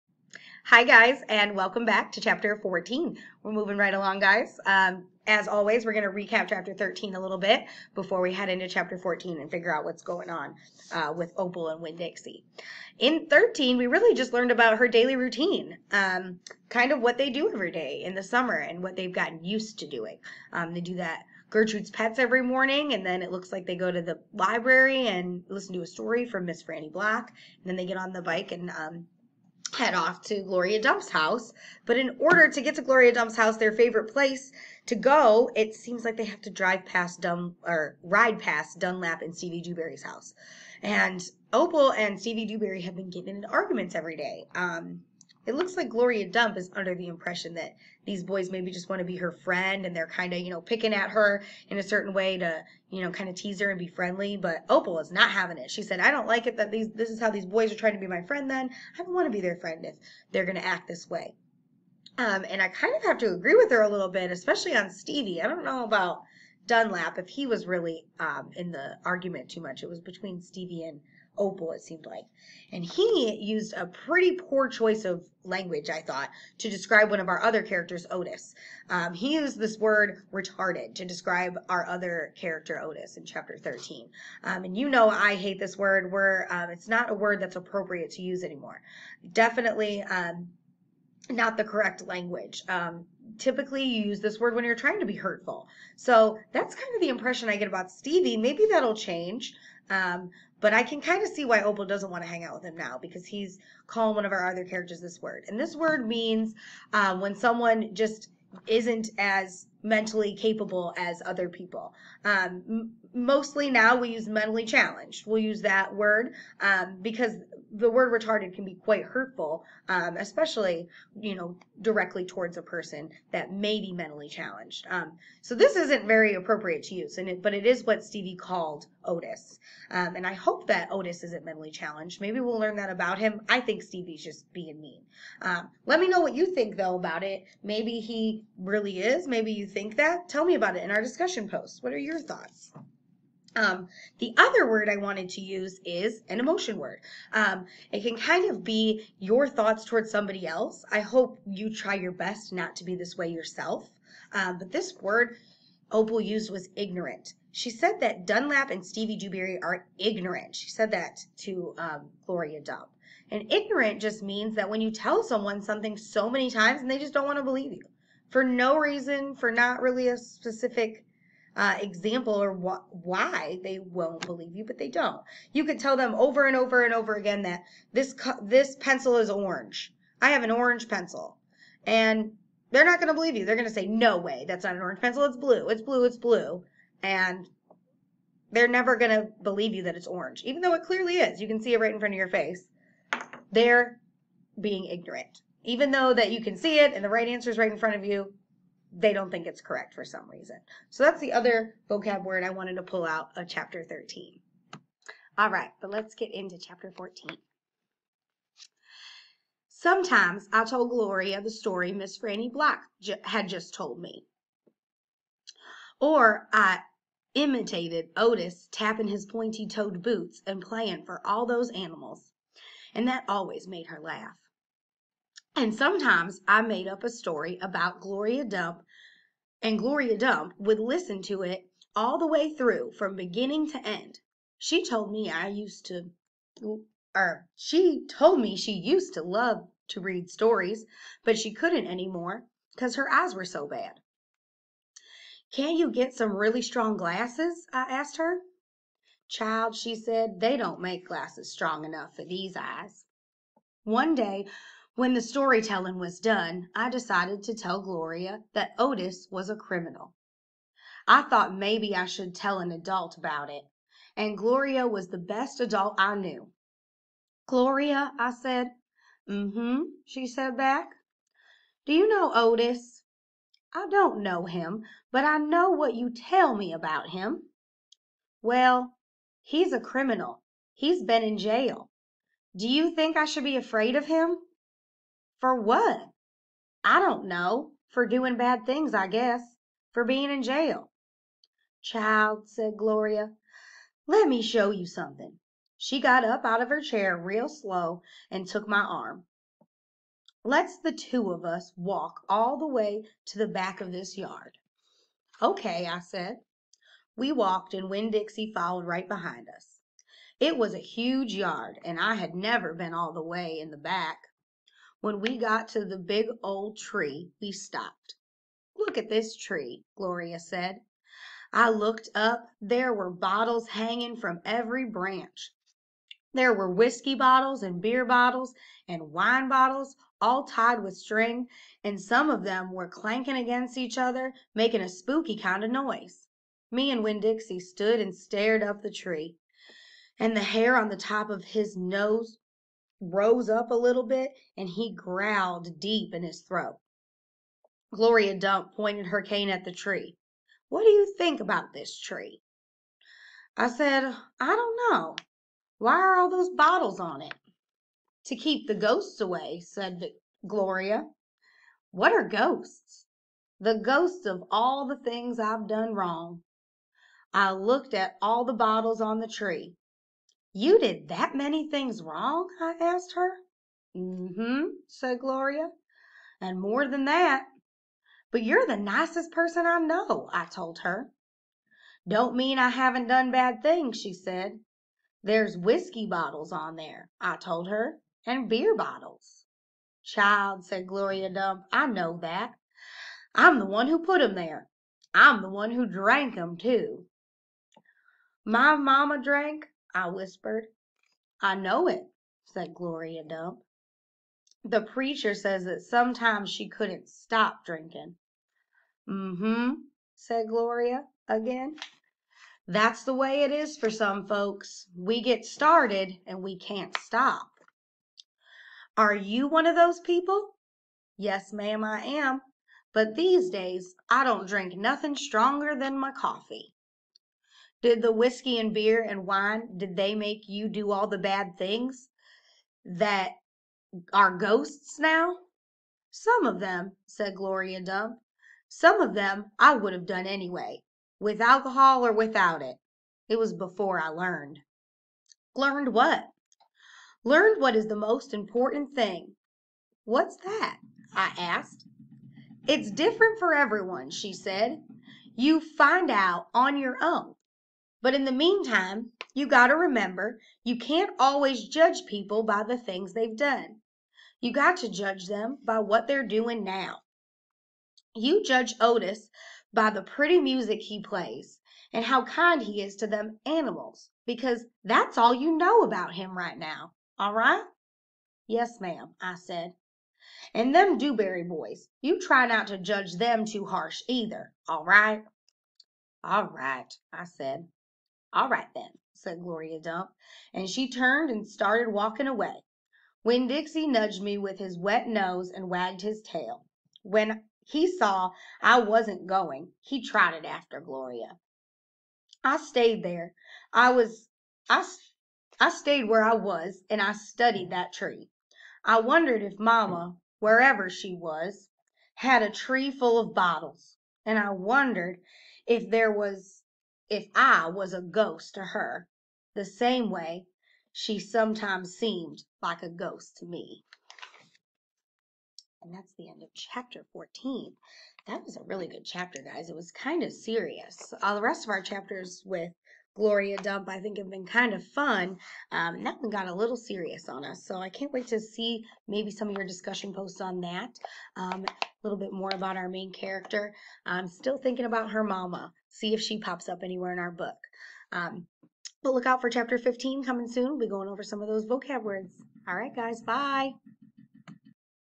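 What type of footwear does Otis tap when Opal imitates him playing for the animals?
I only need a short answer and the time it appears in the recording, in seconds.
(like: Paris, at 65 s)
Pointy toed boots, at 219 s.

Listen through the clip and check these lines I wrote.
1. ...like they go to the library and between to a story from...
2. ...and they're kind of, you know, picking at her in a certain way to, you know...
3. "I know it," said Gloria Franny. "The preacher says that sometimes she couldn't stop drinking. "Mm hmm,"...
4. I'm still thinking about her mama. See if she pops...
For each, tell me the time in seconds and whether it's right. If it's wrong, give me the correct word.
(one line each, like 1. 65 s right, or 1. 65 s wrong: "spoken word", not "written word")
1. 23 s wrong: "listen", not "between"
2. 49 s right
3. 401 s wrong: "Dump", not "Franny"
4. 544 s right.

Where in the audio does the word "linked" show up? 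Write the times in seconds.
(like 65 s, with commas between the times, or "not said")
not said.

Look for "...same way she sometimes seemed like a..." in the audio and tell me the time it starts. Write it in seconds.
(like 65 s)
519 s.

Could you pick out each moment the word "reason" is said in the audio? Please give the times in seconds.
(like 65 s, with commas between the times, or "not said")
168 s, 200 s.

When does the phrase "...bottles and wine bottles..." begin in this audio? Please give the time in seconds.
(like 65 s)
328 s.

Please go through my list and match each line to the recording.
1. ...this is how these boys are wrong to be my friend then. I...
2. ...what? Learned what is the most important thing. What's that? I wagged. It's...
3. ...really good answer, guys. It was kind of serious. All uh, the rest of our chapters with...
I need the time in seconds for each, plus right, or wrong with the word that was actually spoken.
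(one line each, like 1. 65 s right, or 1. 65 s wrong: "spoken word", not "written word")
1. 56 s wrong: "trying", not "wrong"
2. 445 s wrong: "asked", not "wagged"
3. 528 s wrong: "chapter", not "answer".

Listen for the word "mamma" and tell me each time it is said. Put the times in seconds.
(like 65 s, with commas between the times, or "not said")
398 s, 509 s.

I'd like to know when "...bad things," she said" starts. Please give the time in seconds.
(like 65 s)
383 s.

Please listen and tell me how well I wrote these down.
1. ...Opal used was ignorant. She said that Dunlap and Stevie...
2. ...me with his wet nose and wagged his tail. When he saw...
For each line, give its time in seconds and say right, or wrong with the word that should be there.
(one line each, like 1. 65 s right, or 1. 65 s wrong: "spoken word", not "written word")
1. 155 s right
2. 494 s right.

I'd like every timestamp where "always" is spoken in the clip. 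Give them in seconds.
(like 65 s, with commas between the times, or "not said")
5 s, 223 s, 461 s.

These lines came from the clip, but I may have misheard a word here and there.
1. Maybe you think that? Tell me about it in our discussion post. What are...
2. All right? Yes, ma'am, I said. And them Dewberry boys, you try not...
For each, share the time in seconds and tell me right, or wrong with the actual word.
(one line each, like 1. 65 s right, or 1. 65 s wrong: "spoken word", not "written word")
1. 139 s right
2. 477 s right.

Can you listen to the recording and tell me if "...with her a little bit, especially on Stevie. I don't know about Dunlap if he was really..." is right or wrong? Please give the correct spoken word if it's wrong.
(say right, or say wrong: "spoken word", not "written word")
right.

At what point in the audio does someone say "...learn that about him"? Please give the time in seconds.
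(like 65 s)
132 s.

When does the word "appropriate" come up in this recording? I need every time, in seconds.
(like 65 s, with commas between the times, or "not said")
87 s, 126 s.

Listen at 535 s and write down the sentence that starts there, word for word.
Um, that one got a little serious on us.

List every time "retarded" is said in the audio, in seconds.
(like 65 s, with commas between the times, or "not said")
80 s, 118 s.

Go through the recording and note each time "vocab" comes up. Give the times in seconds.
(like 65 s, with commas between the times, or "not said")
201 s, 551 s.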